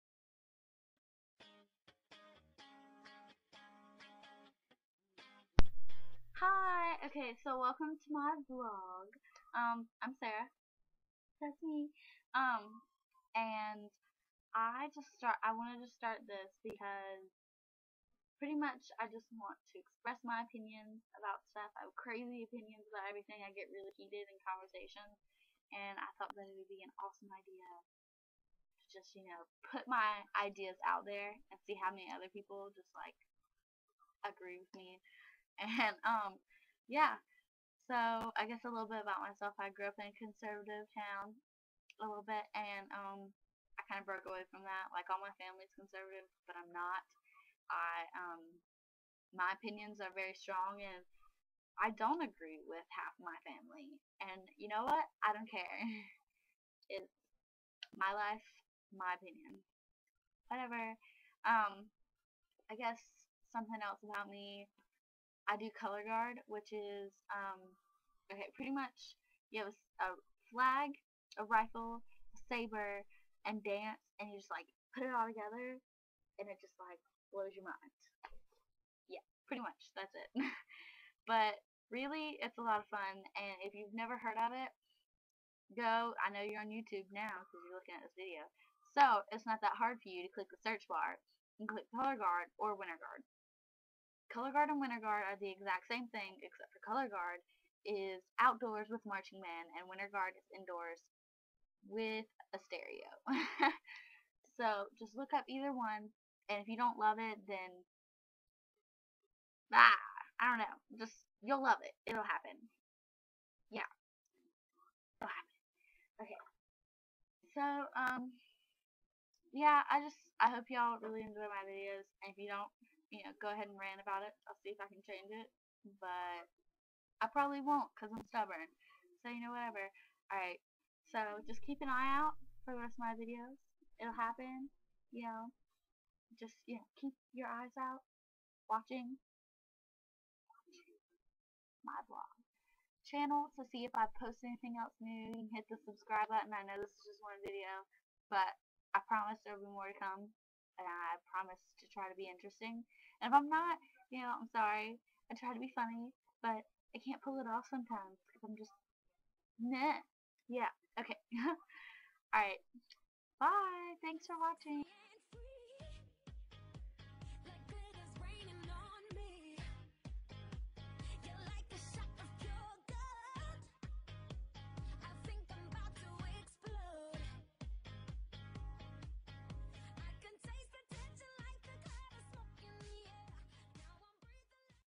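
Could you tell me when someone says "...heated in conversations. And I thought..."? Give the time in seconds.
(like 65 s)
23 s.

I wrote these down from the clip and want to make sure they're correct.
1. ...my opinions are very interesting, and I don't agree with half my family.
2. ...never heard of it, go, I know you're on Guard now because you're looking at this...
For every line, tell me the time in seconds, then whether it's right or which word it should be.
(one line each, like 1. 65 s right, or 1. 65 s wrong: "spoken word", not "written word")
1. 49 s wrong: "strong", not "interesting"
2. 83 s wrong: "YouTube", not "Guard".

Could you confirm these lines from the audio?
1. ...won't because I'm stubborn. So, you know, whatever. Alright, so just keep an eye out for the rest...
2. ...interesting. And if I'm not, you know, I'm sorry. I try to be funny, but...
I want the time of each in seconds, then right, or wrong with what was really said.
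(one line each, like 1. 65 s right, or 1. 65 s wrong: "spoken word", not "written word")
1. 127 s right
2. 152 s right.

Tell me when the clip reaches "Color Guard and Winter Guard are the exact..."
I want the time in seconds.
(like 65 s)
94 s.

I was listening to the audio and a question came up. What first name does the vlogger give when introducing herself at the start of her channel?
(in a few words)
Sarah.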